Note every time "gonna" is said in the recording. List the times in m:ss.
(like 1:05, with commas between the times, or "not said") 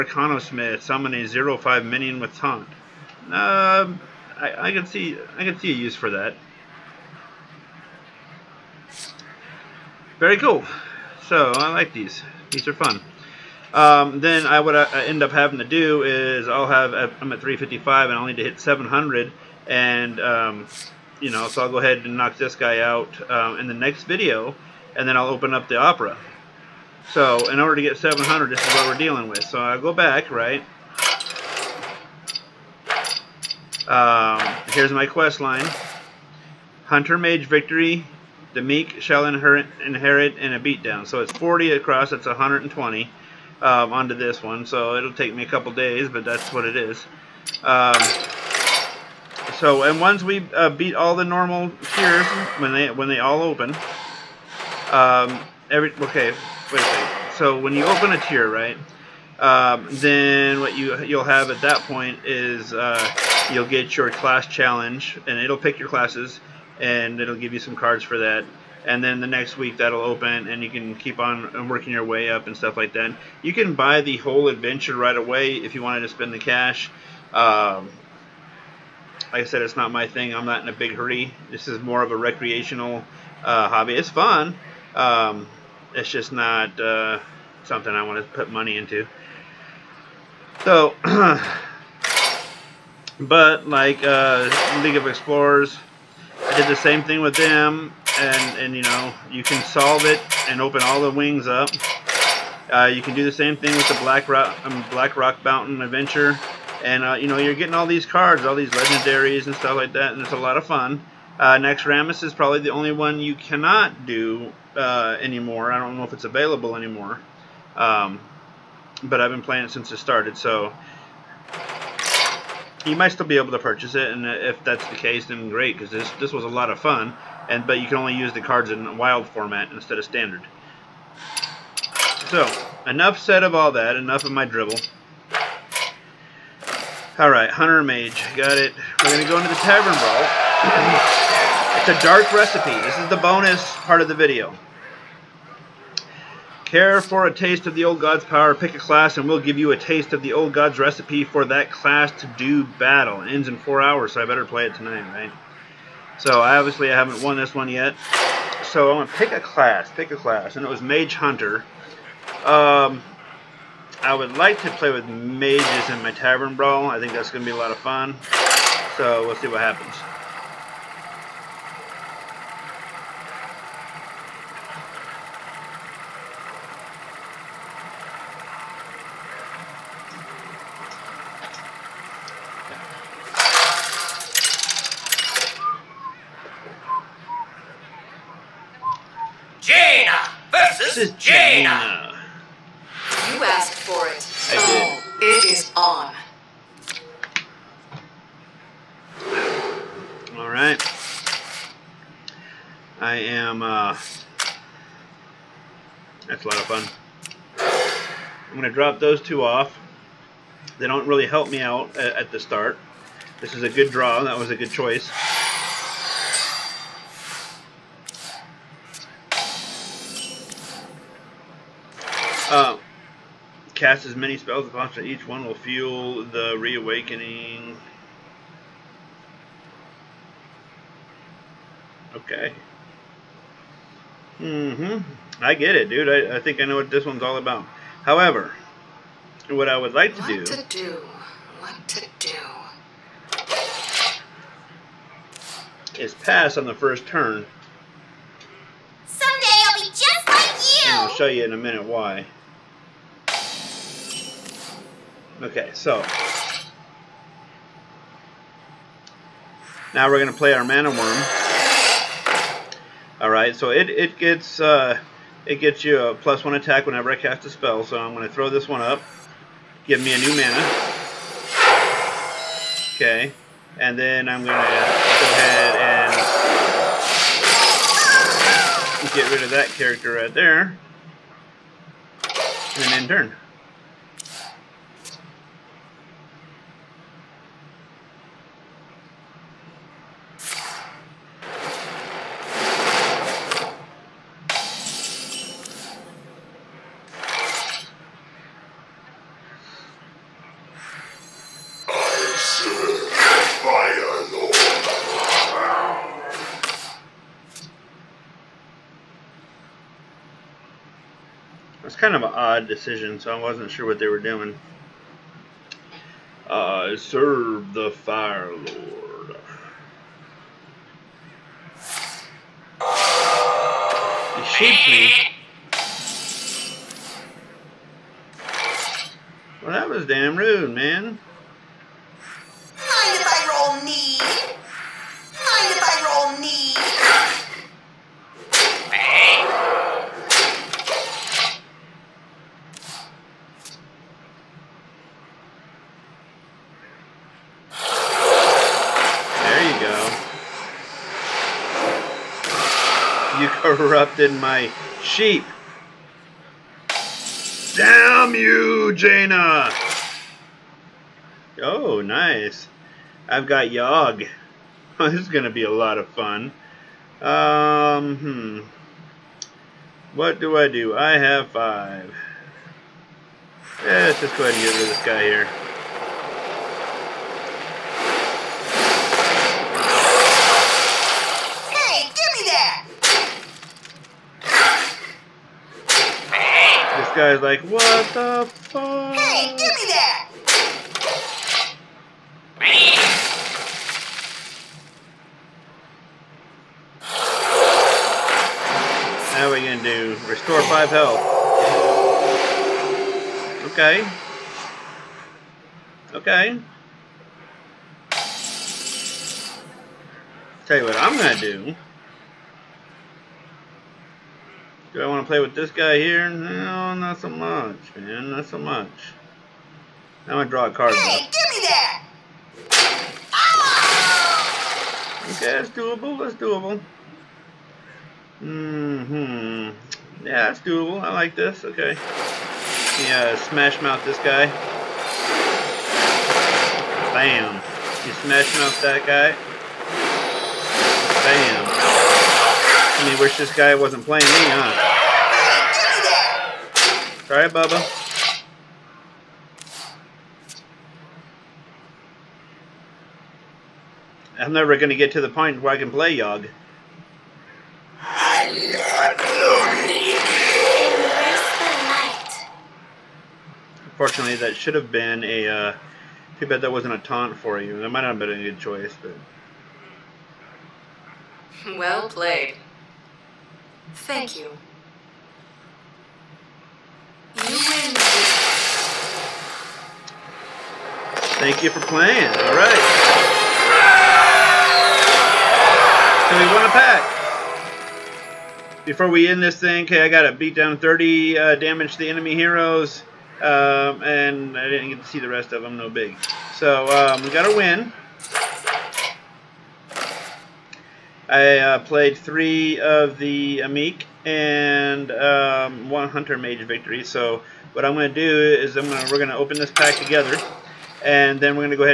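2:39, 6:39, 6:51, 8:28.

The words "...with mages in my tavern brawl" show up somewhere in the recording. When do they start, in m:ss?
2:44.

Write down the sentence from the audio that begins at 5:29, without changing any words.
Well, that was damn rude, man.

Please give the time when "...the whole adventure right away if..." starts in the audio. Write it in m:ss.
1:14.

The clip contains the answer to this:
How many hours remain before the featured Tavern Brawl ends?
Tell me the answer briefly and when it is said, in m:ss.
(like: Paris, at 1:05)
4, at 2:33.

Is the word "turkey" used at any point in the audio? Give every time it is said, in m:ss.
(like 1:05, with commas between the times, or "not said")
not said.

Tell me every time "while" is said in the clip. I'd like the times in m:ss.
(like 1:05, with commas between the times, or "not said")
not said.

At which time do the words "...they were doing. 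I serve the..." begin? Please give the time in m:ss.
5:13.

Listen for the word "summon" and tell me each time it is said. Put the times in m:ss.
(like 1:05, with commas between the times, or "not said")
0:00.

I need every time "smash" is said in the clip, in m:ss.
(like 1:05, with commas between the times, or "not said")
7:13, 7:18.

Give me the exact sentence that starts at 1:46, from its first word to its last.
And, uh, you know, you're getting all these cards, all these legendaries and stuff like that, and it's a lot of fun.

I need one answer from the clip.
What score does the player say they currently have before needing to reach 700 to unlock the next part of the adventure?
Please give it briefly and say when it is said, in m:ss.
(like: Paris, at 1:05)
355, at 0:17.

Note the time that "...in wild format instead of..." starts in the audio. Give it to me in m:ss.
2:08.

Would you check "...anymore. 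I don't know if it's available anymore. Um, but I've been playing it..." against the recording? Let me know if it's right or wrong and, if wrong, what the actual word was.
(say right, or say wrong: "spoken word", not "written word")
right.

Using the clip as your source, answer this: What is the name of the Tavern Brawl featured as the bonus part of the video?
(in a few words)
A Dark Recipe.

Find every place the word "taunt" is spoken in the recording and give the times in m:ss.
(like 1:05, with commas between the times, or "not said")
0:02, 7:46.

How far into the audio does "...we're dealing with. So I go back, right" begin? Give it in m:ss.
0:28.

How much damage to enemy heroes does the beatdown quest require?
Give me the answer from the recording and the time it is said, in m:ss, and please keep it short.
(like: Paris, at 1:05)
30, at 8:10.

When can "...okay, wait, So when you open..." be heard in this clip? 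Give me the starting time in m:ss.
0:56.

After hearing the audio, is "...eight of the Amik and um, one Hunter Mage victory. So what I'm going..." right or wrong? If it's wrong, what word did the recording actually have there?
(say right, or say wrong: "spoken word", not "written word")
wrong: "three", not "eight".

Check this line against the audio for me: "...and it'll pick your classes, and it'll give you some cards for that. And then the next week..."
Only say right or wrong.
right.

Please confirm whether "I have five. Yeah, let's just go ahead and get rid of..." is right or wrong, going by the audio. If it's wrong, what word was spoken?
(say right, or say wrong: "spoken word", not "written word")
right.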